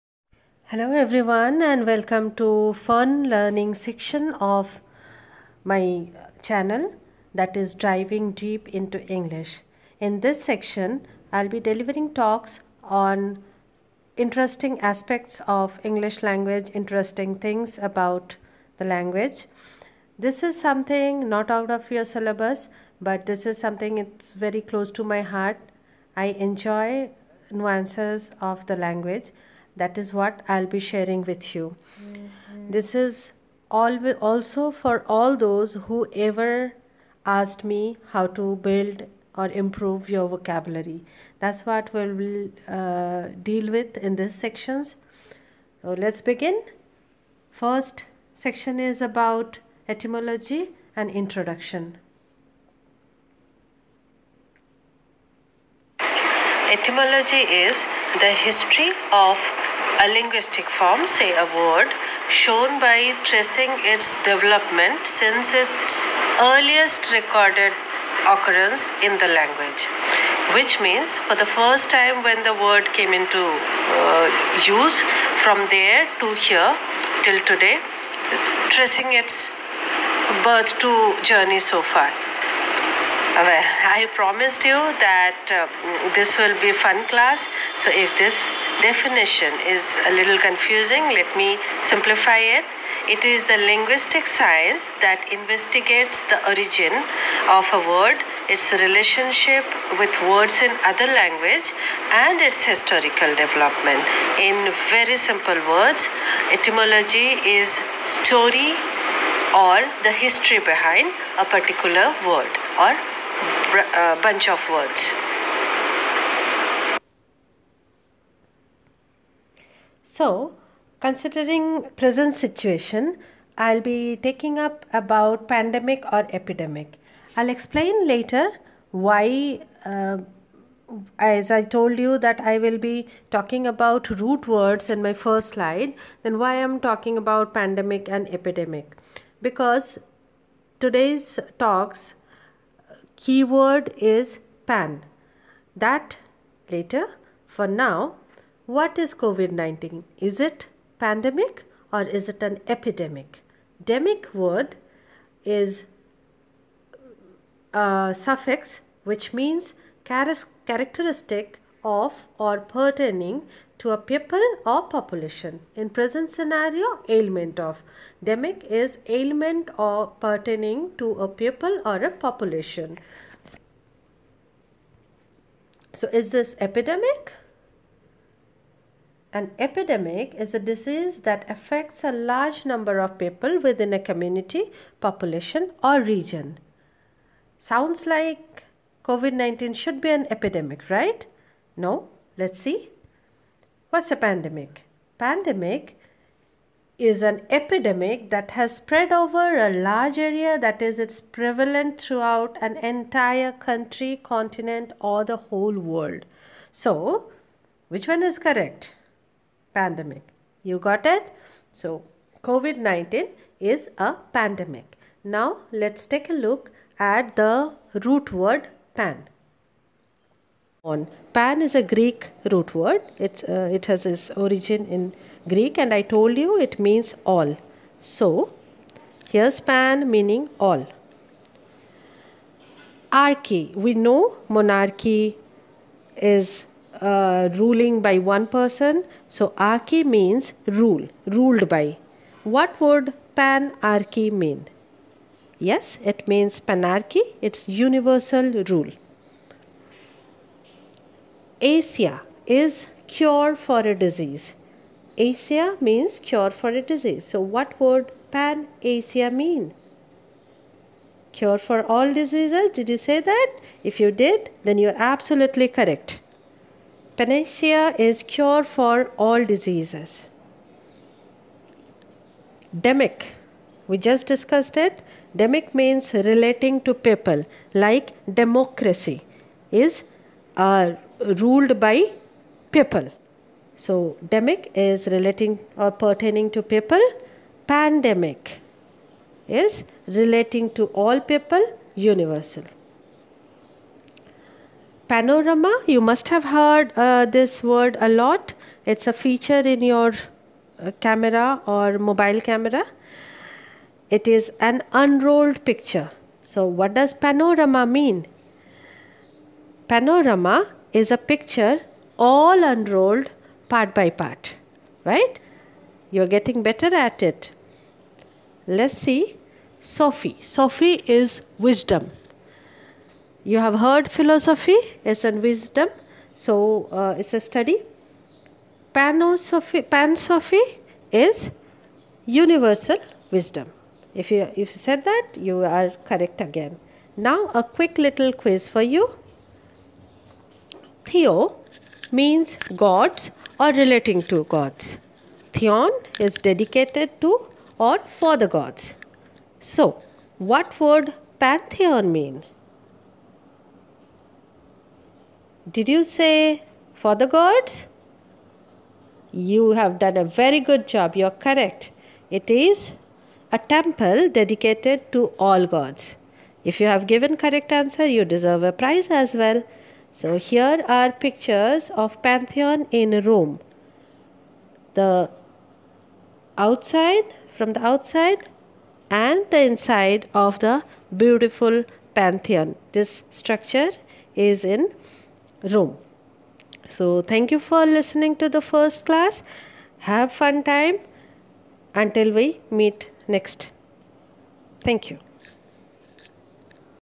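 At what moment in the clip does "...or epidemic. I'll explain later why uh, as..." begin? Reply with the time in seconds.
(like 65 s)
126 s.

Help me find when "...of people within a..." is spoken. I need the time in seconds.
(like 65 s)
182 s.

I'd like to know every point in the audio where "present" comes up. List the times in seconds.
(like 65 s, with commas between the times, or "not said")
121 s, 165 s.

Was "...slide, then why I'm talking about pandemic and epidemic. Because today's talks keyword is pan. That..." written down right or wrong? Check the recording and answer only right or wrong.
right.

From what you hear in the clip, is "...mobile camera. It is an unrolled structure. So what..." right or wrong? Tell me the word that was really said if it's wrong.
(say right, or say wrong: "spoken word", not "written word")
wrong: "picture", not "structure".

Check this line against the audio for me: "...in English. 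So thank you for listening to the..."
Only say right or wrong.
wrong.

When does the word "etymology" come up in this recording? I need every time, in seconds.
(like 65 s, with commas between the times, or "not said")
49 s, 56 s, 106 s.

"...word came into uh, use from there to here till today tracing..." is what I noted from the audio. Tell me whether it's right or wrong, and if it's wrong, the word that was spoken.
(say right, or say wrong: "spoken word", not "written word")
right.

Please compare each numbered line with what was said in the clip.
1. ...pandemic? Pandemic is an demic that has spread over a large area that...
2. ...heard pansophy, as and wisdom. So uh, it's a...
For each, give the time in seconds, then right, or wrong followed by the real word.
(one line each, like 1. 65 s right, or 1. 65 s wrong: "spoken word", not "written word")
1. 194 s wrong: "epidemic", not "demic"
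2. 323 s wrong: "philosophy", not "pansophy".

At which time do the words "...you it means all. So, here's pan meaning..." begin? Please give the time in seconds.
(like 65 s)
226 s.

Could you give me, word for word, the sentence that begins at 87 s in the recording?
So if this definition is a little confusing, let me simplify it.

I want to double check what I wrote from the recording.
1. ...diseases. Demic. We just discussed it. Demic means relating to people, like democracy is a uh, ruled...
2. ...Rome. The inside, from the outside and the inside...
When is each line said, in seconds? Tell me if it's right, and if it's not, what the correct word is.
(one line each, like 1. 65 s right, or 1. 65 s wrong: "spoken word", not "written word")
1. 269 s right
2. 373 s wrong: "outside", not "inside".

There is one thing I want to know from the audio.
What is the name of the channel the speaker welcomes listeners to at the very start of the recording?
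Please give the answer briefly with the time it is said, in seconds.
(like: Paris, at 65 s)
Driving Deep into English, at 7 s.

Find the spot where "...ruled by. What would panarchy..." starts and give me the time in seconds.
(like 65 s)
241 s.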